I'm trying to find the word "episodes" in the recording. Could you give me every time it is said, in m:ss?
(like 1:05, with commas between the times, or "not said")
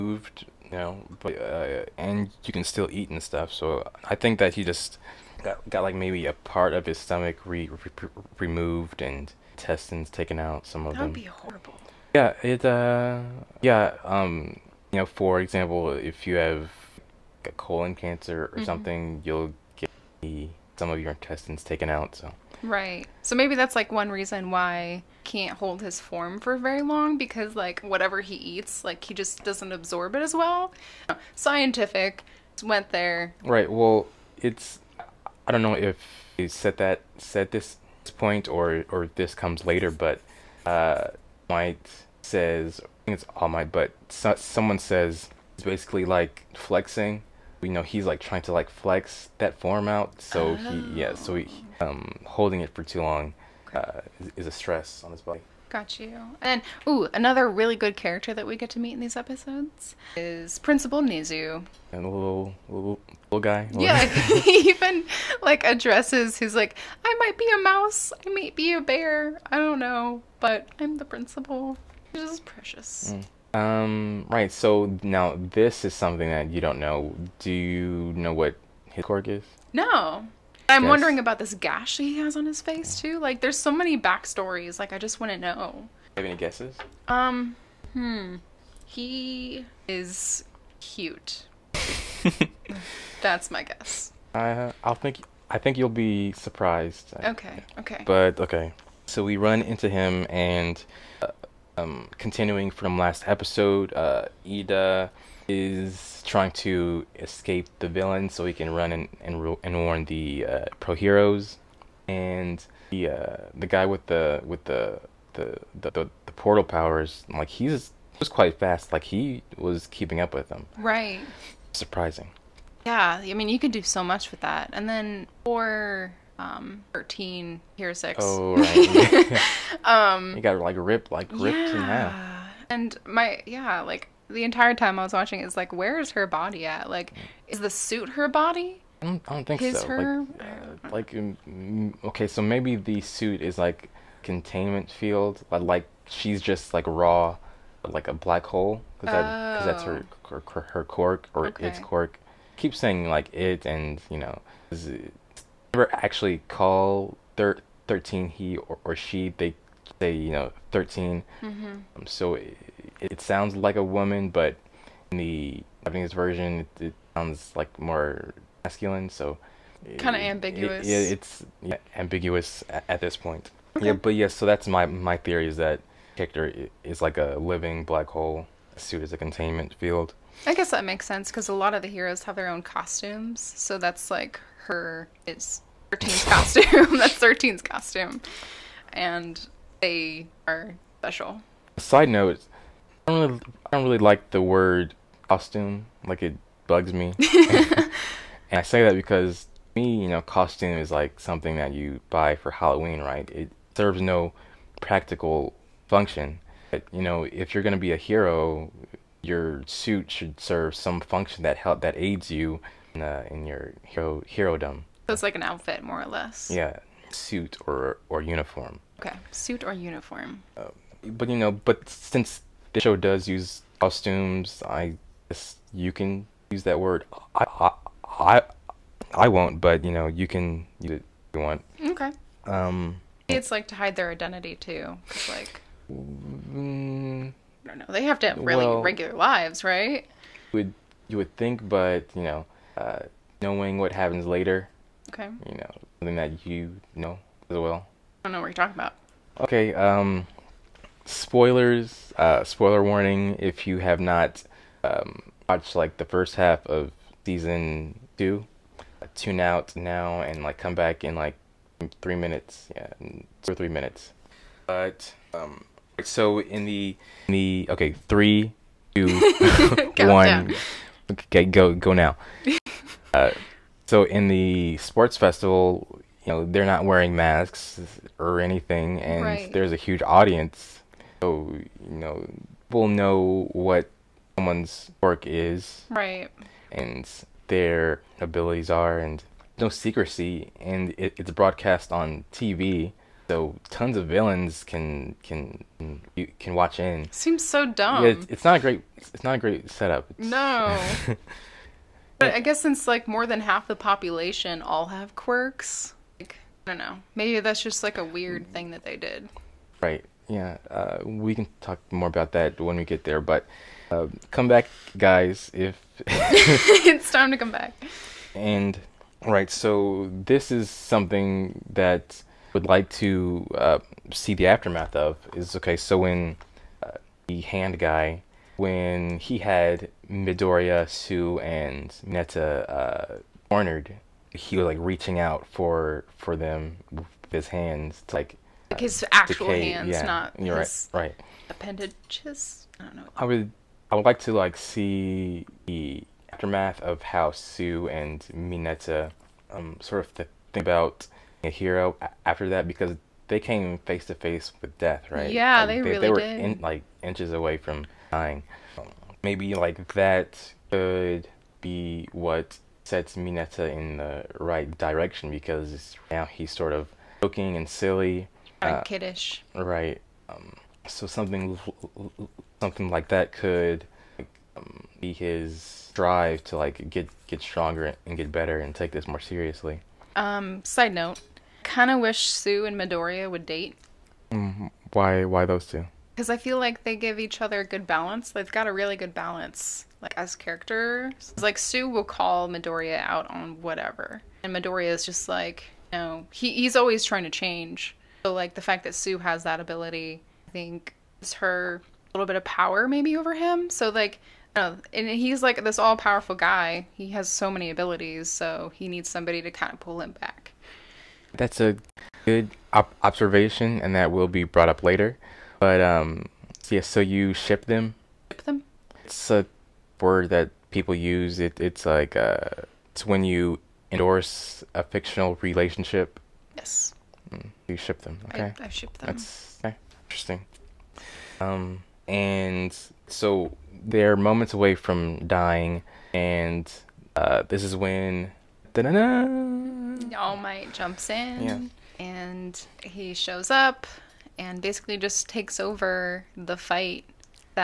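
0:59, 1:43.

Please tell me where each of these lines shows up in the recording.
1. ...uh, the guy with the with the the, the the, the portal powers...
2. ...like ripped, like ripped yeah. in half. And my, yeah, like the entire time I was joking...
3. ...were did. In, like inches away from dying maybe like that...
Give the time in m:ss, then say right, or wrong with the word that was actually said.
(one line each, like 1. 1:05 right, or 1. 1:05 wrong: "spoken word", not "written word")
1. 1:53 right
2. 2:10 wrong: "watching", not "joking"
3. 5:56 right.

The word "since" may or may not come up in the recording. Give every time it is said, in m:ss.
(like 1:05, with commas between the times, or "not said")
3:41, 5:02.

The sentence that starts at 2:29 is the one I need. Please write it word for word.
that's her, her her quirk or okay.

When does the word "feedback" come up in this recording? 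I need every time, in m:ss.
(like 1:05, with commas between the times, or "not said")
not said.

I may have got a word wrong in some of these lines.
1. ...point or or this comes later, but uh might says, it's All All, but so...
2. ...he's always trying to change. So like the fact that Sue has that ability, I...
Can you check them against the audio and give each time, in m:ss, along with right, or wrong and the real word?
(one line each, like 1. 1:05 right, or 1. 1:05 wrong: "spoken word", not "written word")
1. 0:38 wrong: "Might", not "All"
2. 6:36 right.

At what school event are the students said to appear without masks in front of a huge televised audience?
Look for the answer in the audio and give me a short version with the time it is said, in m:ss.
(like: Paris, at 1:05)
The sports festival, at 4:34.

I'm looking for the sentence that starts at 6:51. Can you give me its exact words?
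That's a good op- observation, and that will be brought up later.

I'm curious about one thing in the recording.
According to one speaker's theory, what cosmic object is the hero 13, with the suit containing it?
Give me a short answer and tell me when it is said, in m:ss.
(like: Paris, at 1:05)
A living black hole, at 2:57.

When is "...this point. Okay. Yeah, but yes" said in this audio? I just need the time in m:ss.
2:53.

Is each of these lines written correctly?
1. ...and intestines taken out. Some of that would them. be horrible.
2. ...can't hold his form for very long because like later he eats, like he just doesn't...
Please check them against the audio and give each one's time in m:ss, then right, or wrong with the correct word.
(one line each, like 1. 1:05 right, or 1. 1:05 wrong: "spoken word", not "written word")
1. 0:09 right
2. 0:25 wrong: "whatever", not "later".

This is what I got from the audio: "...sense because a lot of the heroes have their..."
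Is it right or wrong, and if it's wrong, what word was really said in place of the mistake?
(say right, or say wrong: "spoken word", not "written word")
right.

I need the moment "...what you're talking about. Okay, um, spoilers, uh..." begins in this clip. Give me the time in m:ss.
4:08.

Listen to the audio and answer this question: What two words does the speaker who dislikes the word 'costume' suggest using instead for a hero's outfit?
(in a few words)
Suit or uniform.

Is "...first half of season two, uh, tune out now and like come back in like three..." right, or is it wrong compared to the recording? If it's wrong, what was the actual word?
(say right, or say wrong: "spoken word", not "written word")
right.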